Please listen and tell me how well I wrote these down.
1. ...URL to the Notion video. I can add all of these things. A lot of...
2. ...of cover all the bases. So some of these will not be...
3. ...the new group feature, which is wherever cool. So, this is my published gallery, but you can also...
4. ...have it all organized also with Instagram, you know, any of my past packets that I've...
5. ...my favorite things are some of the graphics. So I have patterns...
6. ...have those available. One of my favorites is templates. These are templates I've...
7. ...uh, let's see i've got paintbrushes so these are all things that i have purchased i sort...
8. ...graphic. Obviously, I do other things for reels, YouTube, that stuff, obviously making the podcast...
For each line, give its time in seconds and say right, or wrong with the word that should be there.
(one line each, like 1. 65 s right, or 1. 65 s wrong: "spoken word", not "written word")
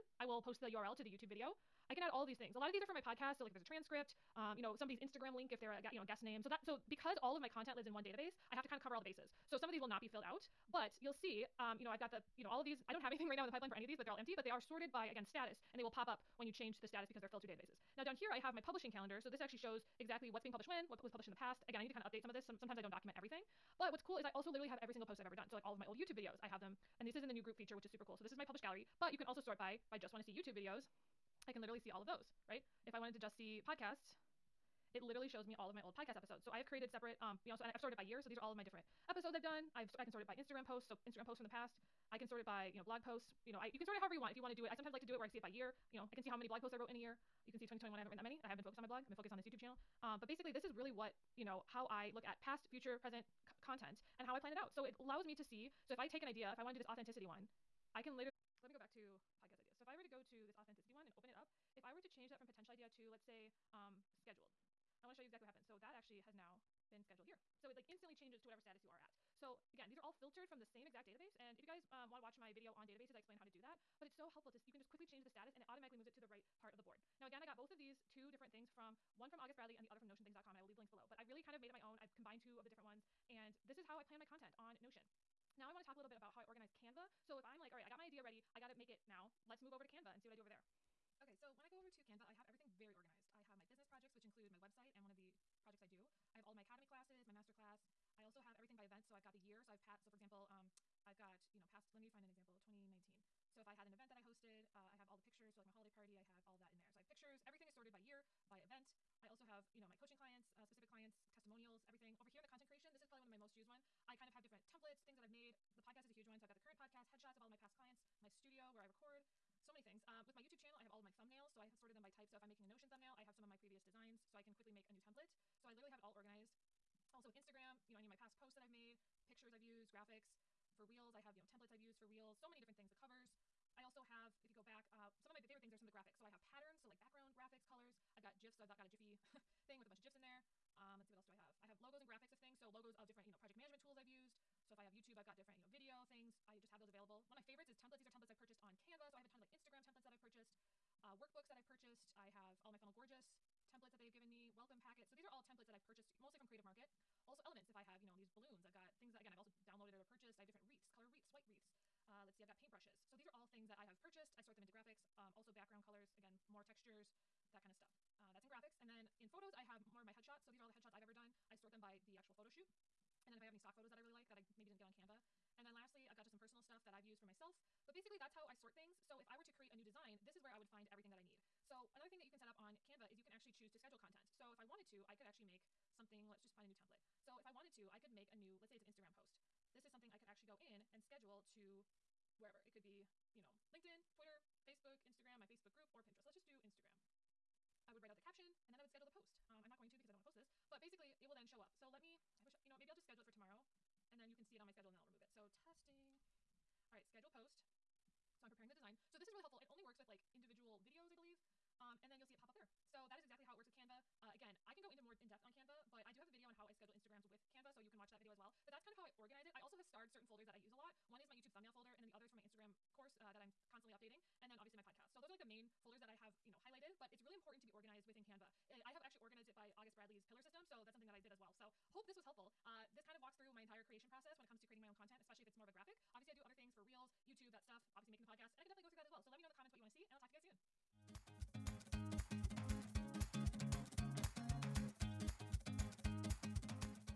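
1. 0 s wrong: "YouTube", not "Notion"
2. 8 s right
3. 27 s wrong: "super", not "wherever"
4. 125 s wrong: "posts", not "packets"
5. 135 s right
6. 146 s right
7. 162 s right
8. 235 s right.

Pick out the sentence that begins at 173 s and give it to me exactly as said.
And then if I have any stock photos that I really like that I maybe didn't get on Canva.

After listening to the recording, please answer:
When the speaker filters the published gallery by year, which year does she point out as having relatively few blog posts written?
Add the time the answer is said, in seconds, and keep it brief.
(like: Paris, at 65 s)
2021, at 47 s.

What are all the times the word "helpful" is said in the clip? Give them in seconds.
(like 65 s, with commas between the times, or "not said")
74 s, 209 s, 232 s.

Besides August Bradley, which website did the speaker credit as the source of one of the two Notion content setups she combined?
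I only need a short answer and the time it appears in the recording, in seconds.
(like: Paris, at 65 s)
notionthings.com, at 80 s.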